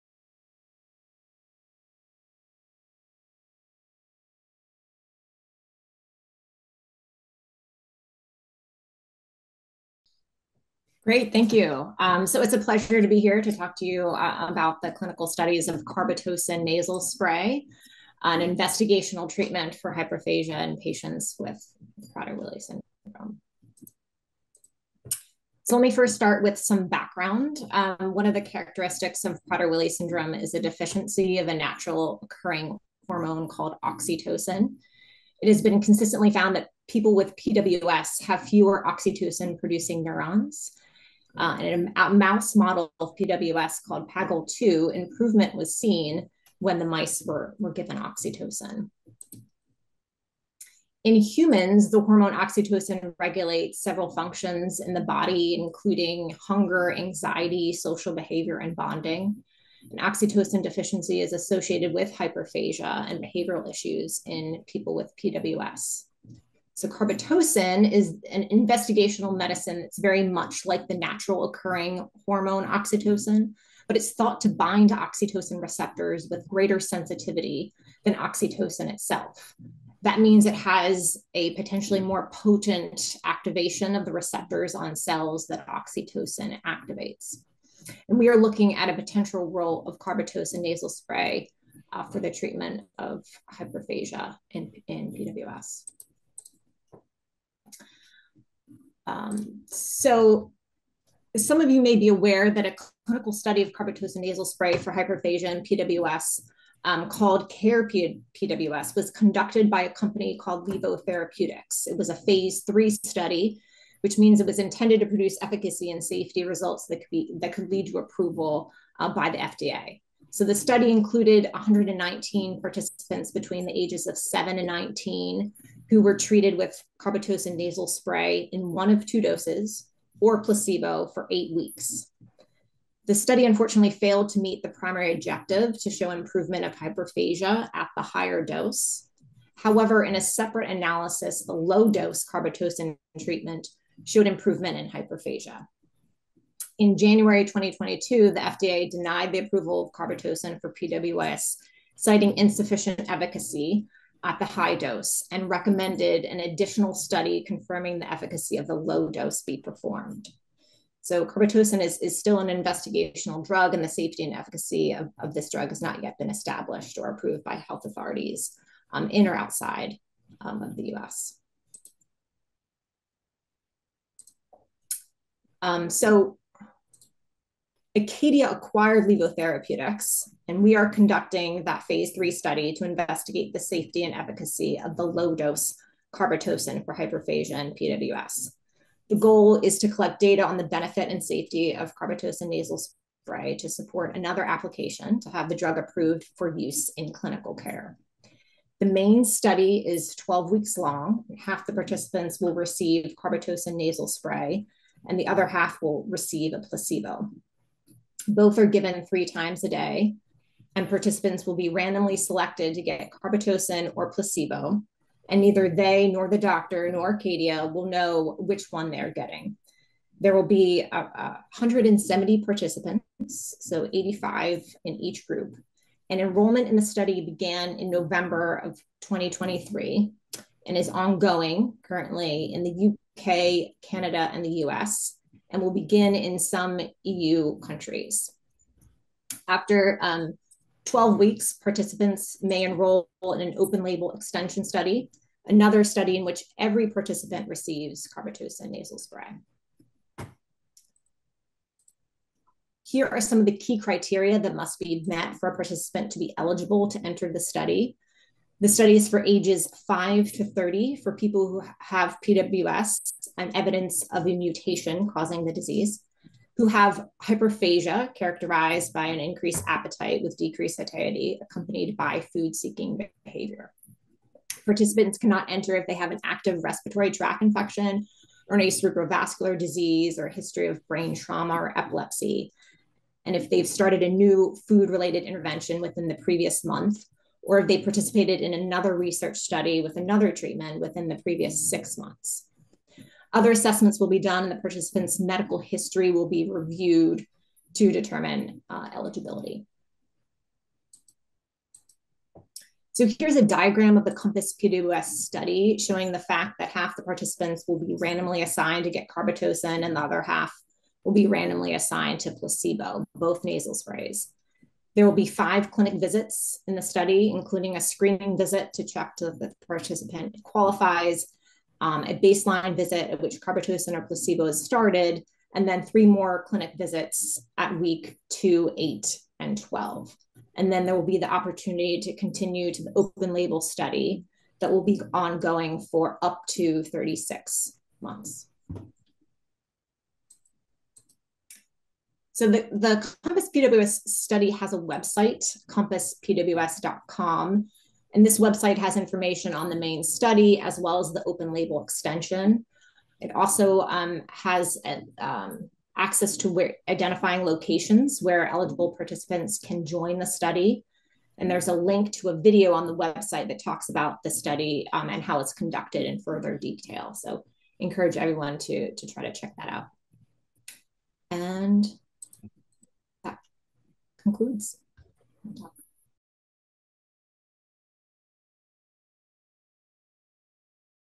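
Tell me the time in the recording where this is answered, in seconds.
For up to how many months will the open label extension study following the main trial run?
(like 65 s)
336 s.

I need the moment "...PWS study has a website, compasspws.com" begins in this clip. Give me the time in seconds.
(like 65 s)
343 s.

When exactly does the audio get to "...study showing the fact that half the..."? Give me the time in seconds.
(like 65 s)
305 s.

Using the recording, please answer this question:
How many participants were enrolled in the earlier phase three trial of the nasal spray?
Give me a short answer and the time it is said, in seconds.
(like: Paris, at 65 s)
119, at 121 s.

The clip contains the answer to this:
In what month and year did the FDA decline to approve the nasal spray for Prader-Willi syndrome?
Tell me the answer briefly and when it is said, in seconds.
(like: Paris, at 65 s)
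January 2022, at 146 s.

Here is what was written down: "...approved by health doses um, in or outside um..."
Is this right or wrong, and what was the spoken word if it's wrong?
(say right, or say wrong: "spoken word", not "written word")
wrong: "authorities", not "doses".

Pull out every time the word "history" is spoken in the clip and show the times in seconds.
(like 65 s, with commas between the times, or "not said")
280 s, 295 s.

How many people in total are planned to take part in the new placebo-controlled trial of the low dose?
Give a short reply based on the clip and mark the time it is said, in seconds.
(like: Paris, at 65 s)
170, at 221 s.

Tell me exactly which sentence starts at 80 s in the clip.
That means it has a potentially more potent activation of the receptors on cells that oxytocin activates.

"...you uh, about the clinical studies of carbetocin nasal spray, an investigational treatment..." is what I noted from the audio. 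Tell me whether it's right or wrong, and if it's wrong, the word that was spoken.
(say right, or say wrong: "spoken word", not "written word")
right.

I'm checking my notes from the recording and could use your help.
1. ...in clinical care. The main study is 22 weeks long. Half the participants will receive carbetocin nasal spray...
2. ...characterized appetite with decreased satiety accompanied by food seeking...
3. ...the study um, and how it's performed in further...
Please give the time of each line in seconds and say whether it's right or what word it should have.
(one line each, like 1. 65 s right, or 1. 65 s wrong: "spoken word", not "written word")
1. 196 s wrong: "12", not "22"
2. 269 s wrong: "increased", not "characterized"
3. 364 s wrong: "conducted", not "performed".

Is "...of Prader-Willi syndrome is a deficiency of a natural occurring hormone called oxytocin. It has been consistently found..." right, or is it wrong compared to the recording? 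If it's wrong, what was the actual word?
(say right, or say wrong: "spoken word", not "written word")
right.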